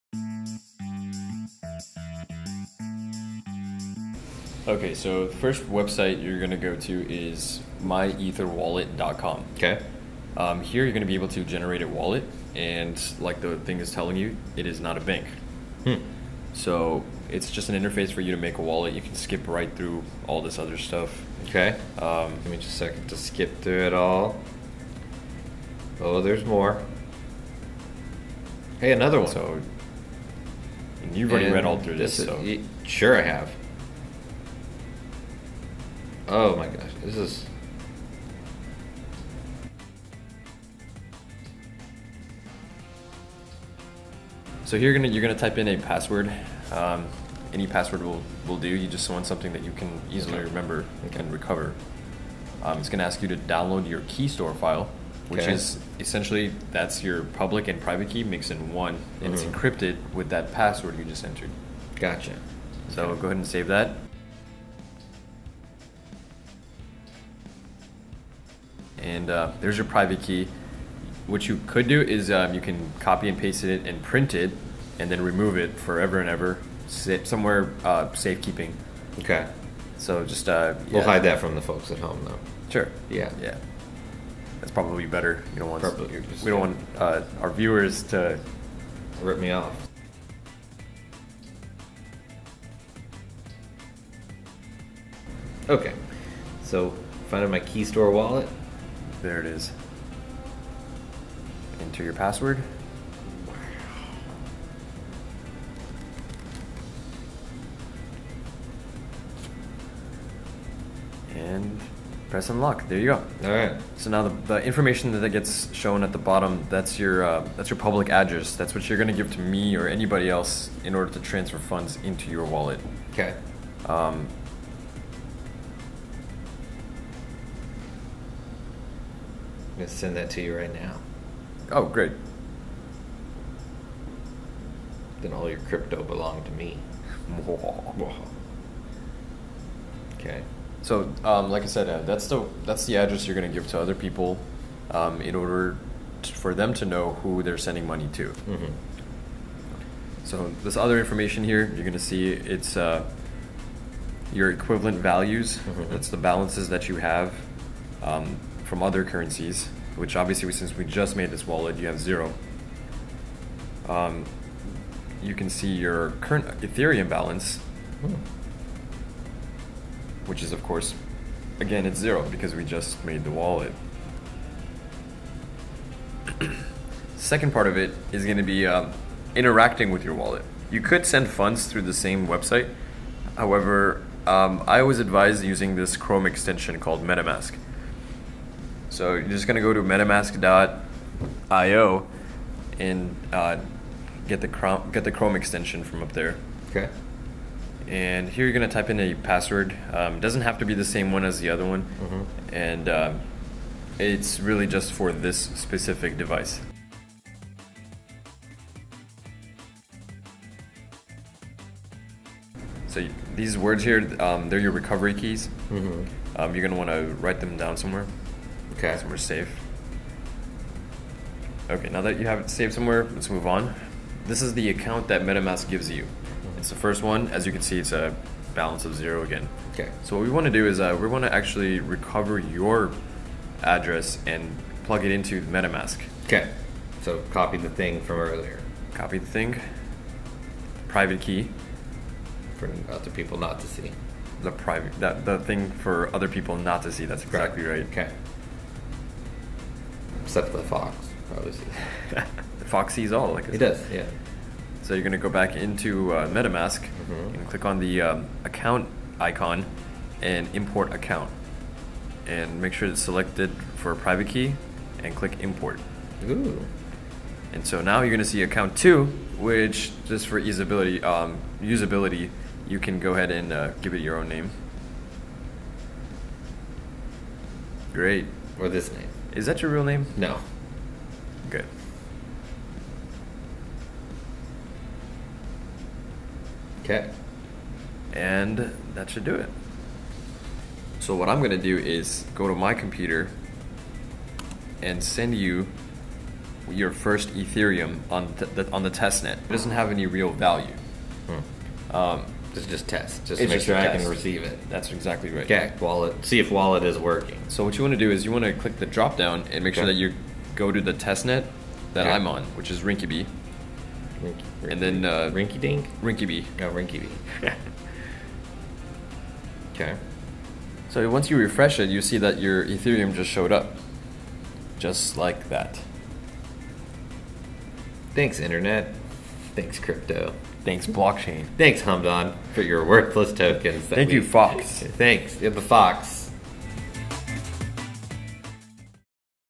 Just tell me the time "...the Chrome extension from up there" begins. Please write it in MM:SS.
03:15.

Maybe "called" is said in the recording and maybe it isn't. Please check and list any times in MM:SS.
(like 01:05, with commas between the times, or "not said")
03:06.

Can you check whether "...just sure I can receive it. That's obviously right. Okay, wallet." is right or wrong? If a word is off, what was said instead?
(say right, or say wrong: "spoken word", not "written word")
wrong: "exactly", not "obviously".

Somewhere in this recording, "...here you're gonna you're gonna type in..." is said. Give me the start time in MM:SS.
00:44.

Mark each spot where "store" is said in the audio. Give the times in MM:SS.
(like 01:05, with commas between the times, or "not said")
00:54, 01:37.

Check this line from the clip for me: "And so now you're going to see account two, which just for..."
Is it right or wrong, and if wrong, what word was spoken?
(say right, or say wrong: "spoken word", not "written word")
right.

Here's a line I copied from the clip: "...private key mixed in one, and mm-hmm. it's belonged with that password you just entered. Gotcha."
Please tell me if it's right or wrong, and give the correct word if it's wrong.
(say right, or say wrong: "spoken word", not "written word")
wrong: "encrypted", not "belonged".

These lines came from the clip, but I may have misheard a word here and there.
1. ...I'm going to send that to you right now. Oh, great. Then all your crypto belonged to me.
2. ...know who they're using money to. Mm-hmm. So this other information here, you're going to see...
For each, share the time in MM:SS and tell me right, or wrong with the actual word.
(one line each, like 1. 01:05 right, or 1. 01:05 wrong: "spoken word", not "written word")
1. 02:09 right
2. 02:26 wrong: "sending", not "using".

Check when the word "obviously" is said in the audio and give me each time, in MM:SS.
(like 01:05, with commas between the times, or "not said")
02:40, 04:11.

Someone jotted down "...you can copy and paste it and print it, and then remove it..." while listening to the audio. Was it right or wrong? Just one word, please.
right.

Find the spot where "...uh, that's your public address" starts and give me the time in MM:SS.
01:57.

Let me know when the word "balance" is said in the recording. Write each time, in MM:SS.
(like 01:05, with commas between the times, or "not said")
02:36, 02:47, 03:48.